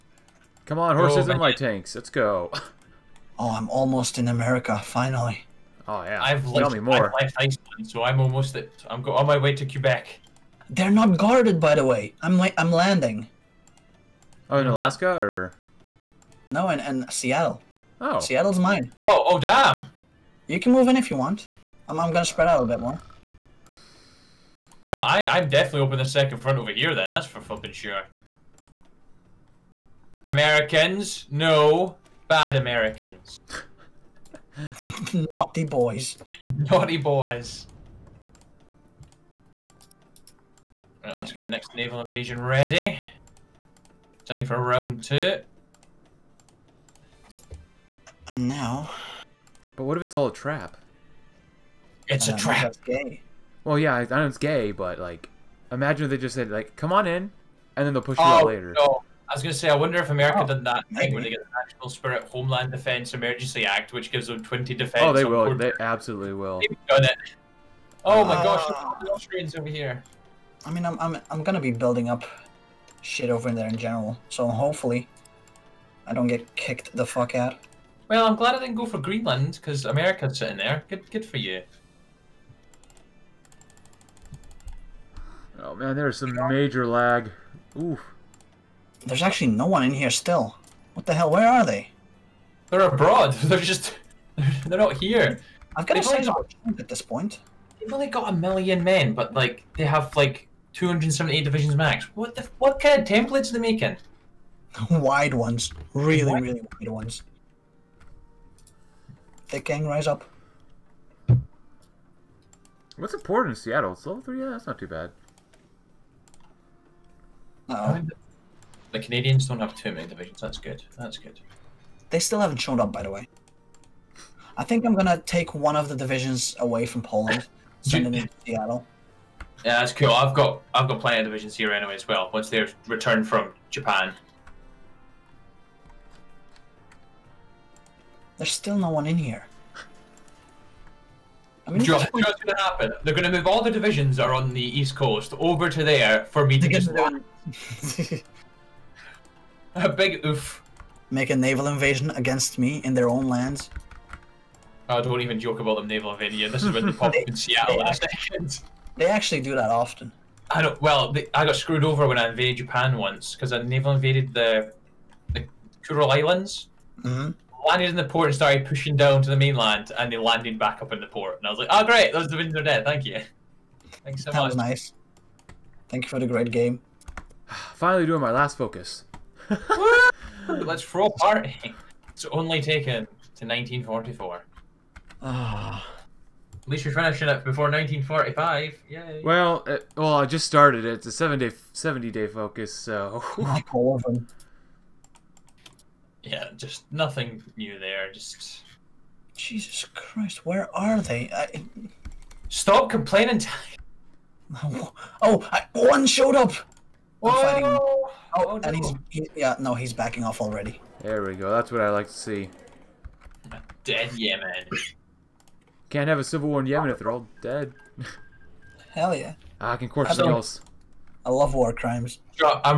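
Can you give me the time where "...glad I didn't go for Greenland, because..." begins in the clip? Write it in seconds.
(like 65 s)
78 s.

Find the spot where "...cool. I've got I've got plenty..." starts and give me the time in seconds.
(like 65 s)
129 s.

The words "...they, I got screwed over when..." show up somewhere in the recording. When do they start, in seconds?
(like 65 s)
161 s.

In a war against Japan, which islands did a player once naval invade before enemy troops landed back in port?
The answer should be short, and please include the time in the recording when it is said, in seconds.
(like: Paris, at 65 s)
Kuril Islands, at 165 s.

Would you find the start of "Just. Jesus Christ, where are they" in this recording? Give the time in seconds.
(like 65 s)
198 s.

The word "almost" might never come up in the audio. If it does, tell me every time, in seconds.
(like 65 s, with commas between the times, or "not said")
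3 s, 8 s.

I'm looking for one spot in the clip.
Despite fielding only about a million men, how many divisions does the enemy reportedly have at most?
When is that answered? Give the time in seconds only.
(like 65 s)
100 s.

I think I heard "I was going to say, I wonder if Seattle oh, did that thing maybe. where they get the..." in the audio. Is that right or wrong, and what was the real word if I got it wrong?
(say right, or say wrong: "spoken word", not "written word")
wrong: "America", not "Seattle".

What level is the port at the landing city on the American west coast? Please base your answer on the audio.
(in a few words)
3.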